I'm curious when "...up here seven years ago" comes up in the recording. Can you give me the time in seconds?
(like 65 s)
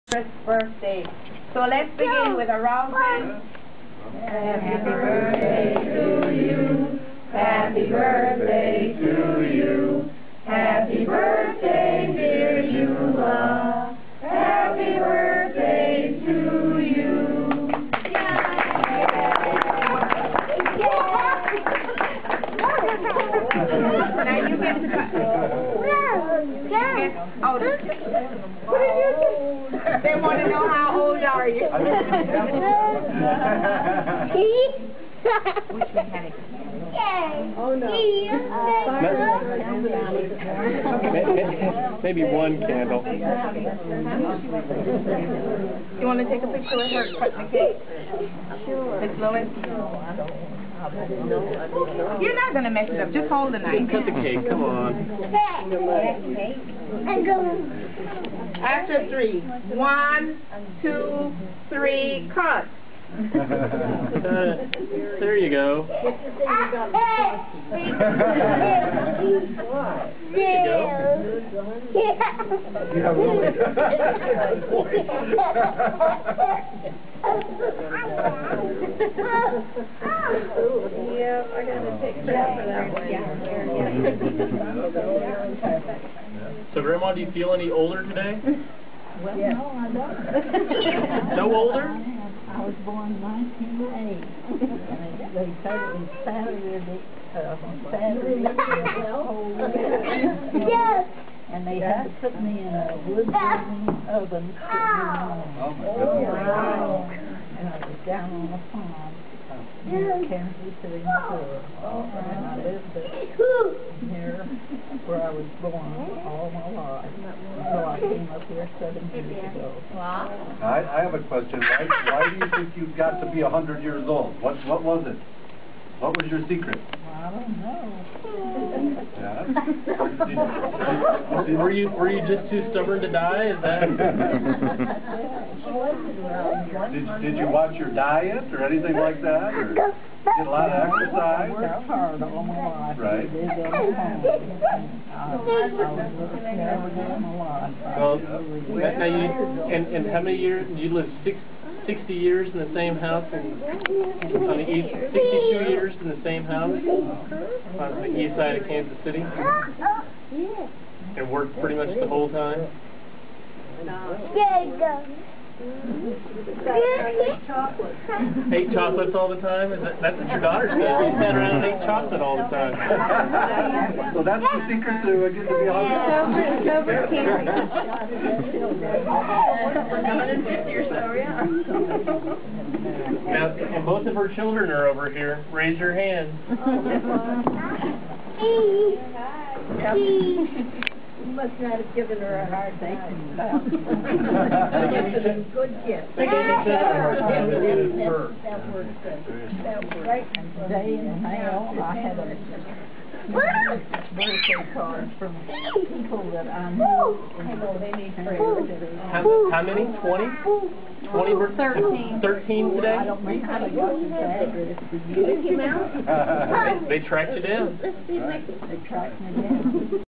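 118 s.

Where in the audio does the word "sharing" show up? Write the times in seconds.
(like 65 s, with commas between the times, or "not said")
not said.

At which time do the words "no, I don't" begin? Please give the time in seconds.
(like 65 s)
89 s.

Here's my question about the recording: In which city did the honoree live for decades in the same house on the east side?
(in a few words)
Kansas City.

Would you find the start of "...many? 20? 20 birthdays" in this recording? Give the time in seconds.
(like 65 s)
209 s.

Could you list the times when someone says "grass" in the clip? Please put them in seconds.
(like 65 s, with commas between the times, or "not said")
not said.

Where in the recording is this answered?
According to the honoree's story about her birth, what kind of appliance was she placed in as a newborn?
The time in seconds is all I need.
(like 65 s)
103 s.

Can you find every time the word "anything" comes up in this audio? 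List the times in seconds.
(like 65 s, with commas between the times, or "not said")
138 s.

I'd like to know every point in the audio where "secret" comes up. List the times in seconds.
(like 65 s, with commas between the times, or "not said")
126 s, 174 s.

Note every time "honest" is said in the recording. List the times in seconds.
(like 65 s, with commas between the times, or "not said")
175 s.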